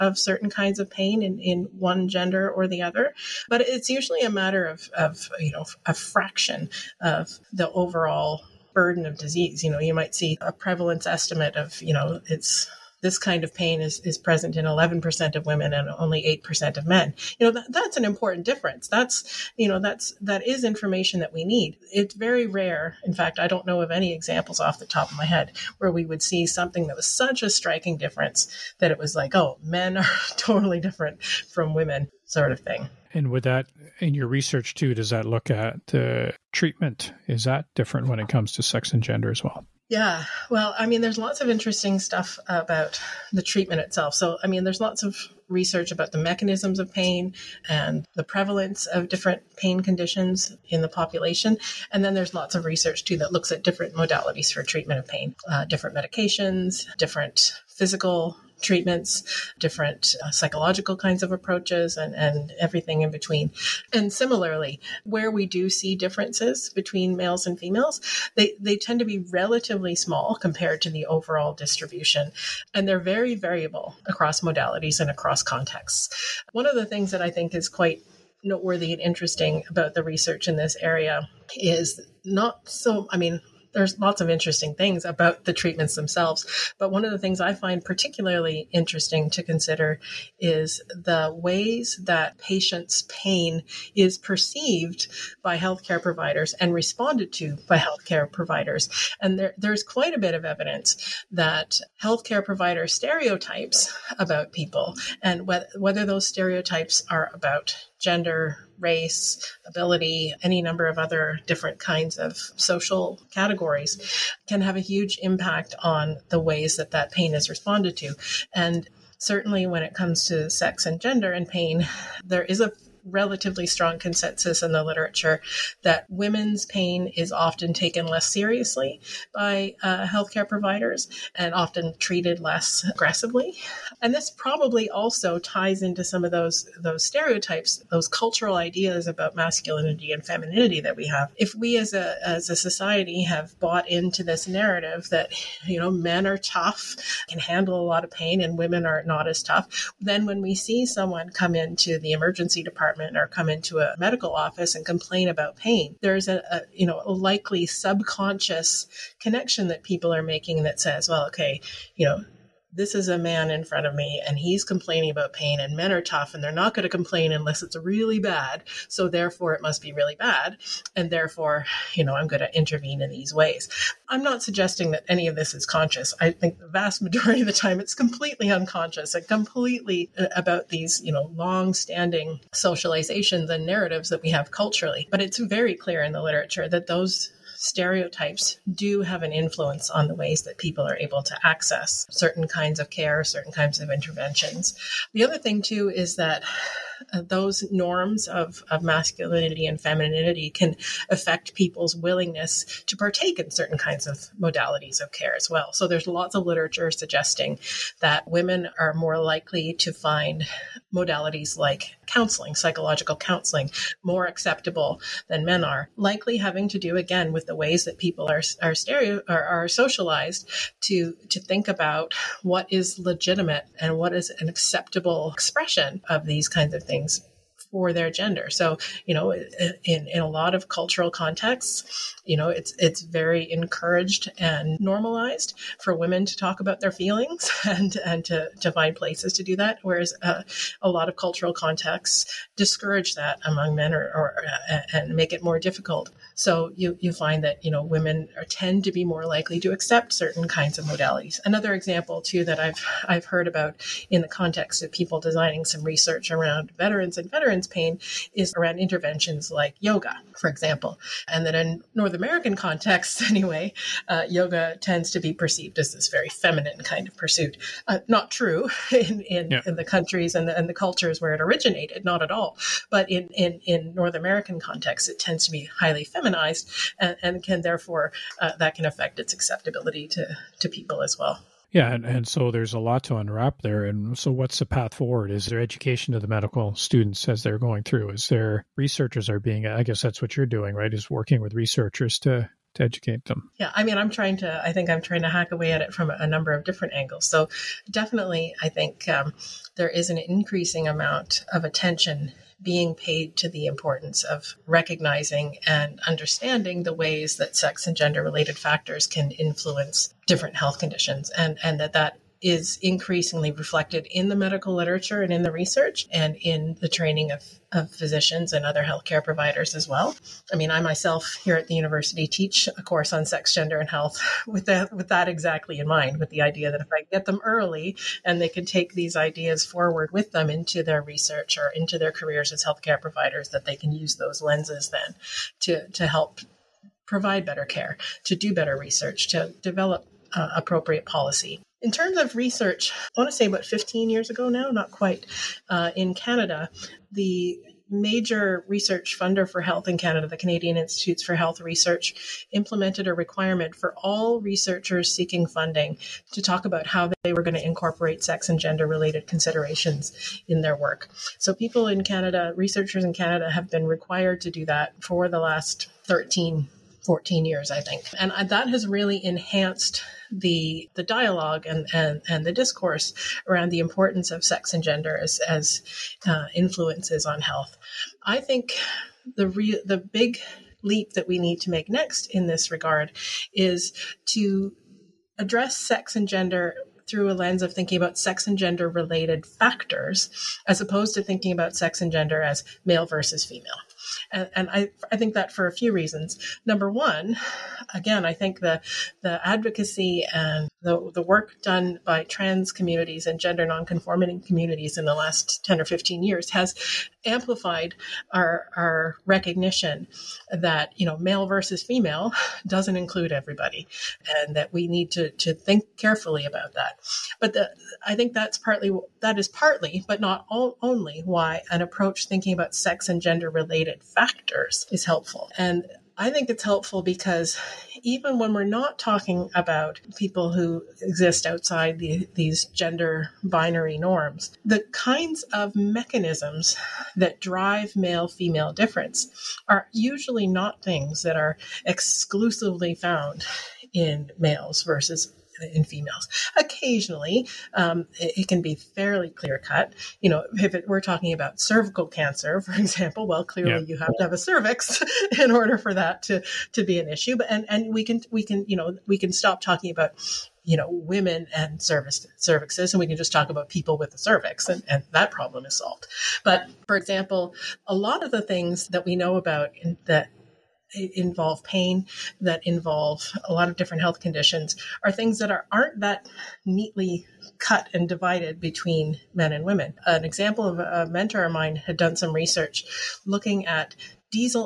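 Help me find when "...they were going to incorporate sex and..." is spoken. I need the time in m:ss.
5:57.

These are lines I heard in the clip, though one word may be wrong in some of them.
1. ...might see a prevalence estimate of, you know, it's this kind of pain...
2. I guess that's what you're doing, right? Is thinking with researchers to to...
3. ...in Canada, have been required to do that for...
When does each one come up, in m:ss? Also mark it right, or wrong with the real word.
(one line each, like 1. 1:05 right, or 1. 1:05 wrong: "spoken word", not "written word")
1. 0:09 right
2. 4:49 wrong: "working", not "thinking"
3. 6:03 right.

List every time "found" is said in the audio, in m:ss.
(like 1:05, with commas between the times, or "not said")
7:22.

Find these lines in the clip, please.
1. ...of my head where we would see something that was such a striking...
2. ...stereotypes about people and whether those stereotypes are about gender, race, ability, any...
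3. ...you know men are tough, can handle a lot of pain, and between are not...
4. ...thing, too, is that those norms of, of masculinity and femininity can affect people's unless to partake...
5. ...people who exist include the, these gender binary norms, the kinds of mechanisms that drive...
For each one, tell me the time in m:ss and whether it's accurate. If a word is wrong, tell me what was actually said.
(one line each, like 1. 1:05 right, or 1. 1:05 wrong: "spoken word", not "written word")
1. 0:25 right
2. 1:42 right
3. 2:25 wrong: "women", not "between"
4. 3:15 wrong: "willingness", not "unless"
5. 7:10 wrong: "outside", not "include".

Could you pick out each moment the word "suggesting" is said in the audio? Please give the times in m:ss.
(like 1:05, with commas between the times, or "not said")
2:54, 3:26.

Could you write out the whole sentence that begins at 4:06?
So you you find that you know women are, tend to be more likely to accept certain kinds of modalities.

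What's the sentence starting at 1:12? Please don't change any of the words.
And they're very variable across modalities and across contexts.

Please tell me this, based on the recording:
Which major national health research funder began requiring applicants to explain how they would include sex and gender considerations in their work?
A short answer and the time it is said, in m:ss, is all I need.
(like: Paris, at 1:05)
Canadian Institutes for Health Research, at 5:50.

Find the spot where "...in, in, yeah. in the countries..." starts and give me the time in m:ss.
4:28.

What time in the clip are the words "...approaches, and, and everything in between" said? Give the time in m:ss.
1:01.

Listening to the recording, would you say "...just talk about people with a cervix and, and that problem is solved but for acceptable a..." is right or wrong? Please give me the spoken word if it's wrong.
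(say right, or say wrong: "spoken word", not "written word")
wrong: "example", not "acceptable".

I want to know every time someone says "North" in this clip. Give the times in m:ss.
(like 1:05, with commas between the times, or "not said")
4:21, 4:33.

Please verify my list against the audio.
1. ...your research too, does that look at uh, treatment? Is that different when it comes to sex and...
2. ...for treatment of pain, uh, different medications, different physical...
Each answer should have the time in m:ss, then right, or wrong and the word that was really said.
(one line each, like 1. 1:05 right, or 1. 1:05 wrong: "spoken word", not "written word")
1. 0:34 right
2. 0:54 right.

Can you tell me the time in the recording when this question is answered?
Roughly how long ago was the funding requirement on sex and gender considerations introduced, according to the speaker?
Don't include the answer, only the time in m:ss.
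5:43.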